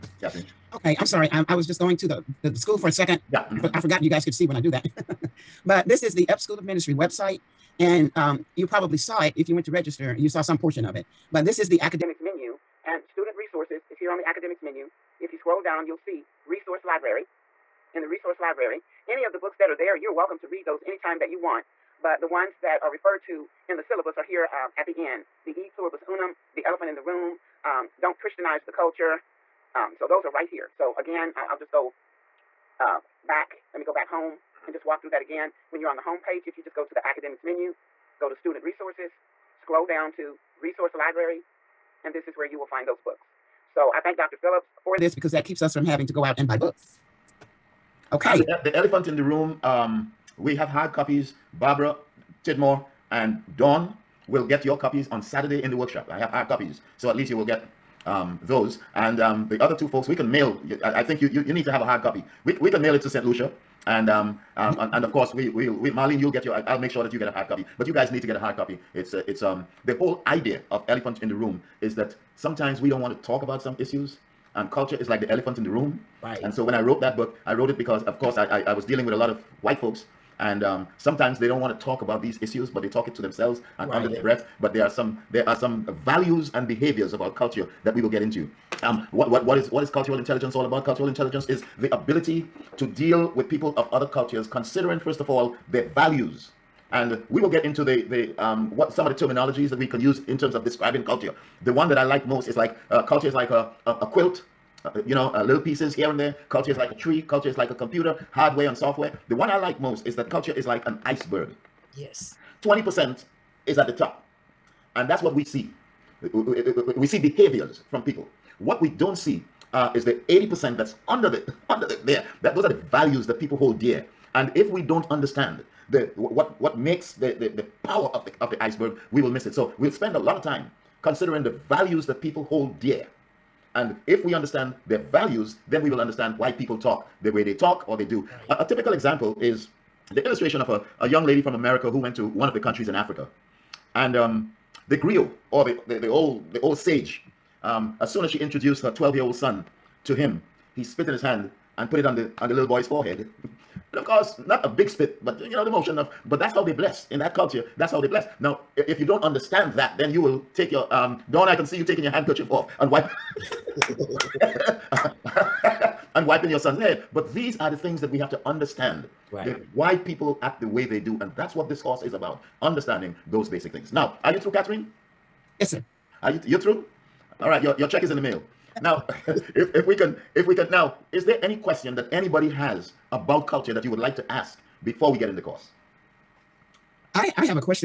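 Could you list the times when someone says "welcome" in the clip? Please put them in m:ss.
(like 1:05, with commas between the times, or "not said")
0:20.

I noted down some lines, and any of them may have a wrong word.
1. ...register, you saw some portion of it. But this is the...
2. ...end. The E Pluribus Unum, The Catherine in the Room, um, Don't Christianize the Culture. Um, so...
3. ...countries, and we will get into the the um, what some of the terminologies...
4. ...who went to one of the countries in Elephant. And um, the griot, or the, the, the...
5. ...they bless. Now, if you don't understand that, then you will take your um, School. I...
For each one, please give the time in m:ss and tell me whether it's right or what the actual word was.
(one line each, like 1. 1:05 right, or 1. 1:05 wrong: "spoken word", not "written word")
1. 0:09 right
2. 0:25 wrong: "Elephant", not "Catherine"
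3. 1:35 wrong: "values", not "countries"
4. 2:21 wrong: "Africa", not "Elephant"
5. 2:37 wrong: "Dawn", not "School".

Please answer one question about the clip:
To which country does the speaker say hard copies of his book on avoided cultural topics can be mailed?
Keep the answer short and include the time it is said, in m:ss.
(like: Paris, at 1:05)
Saint Lucia, at 1:03.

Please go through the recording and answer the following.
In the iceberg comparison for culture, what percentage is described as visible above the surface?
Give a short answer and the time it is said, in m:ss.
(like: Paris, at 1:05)
20%, at 1:52.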